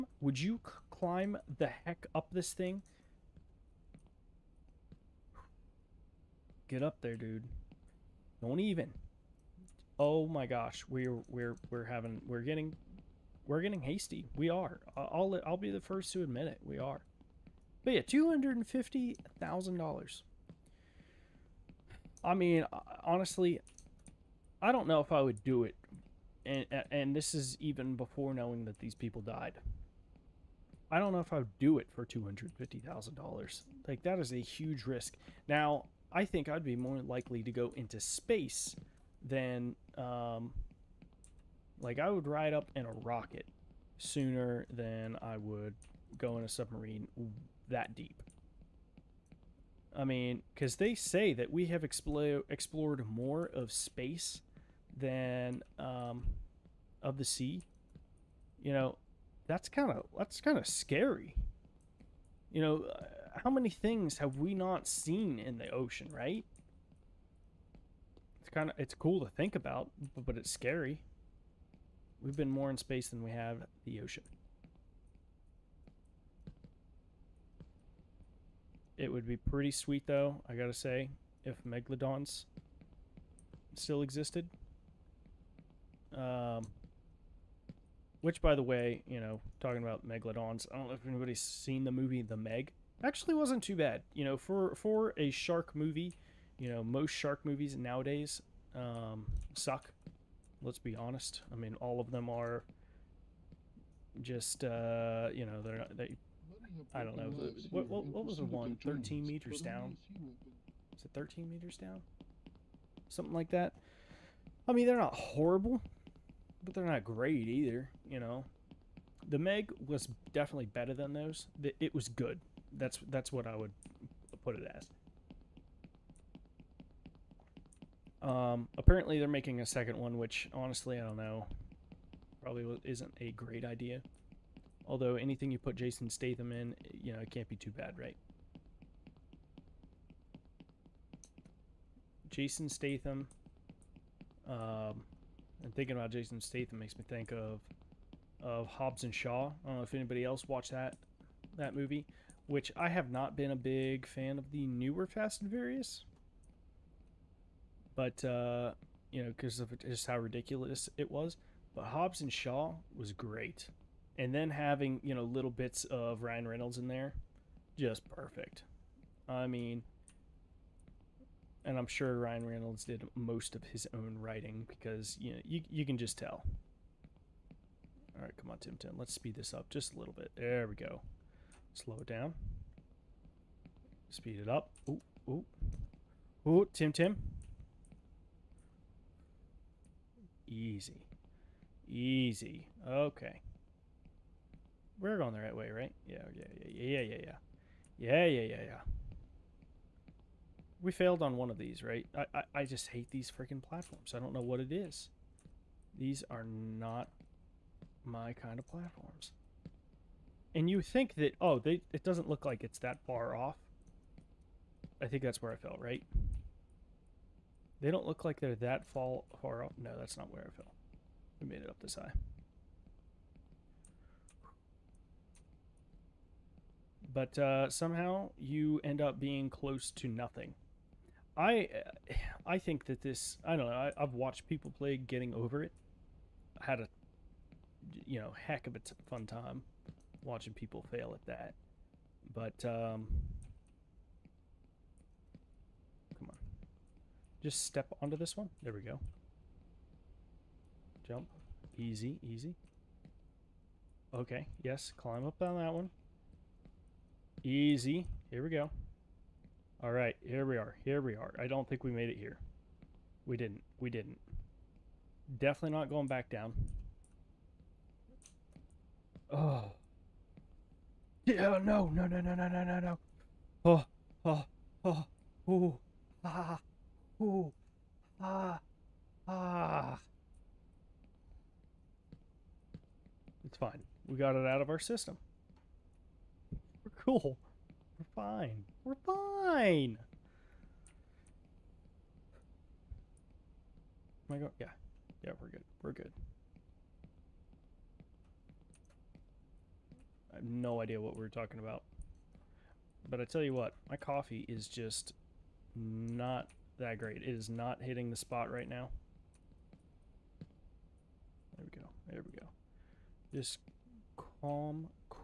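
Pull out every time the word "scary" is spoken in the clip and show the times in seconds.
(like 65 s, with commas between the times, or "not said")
60 s, 70 s.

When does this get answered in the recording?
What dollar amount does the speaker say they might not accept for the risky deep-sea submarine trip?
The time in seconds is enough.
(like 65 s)
32 s.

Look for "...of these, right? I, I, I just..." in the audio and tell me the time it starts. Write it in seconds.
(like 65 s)
201 s.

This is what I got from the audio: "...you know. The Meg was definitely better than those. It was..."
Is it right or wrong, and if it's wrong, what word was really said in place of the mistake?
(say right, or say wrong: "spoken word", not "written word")
right.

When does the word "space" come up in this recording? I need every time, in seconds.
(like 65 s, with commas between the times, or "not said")
38 s, 53 s, 72 s.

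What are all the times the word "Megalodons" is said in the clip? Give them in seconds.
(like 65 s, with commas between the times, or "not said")
81 s, 90 s.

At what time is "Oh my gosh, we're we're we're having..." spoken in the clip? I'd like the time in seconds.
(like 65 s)
9 s.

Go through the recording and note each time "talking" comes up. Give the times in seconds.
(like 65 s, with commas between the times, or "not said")
89 s, 301 s.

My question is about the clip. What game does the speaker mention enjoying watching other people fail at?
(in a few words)
Getting Over It.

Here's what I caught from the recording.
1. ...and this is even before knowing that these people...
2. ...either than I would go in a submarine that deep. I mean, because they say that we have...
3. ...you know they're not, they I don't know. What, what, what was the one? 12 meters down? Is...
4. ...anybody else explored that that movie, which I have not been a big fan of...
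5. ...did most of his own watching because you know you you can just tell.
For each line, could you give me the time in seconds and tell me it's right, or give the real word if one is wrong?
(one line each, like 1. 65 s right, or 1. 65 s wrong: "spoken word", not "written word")
1. 26 s right
2. 43 s wrong: "sooner", not "either"
3. 105 s wrong: "13", not "12"
4. 149 s wrong: "watched", not "explored"
5. 172 s wrong: "writing", not "watching".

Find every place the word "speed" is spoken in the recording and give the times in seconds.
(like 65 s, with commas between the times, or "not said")
179 s, 184 s.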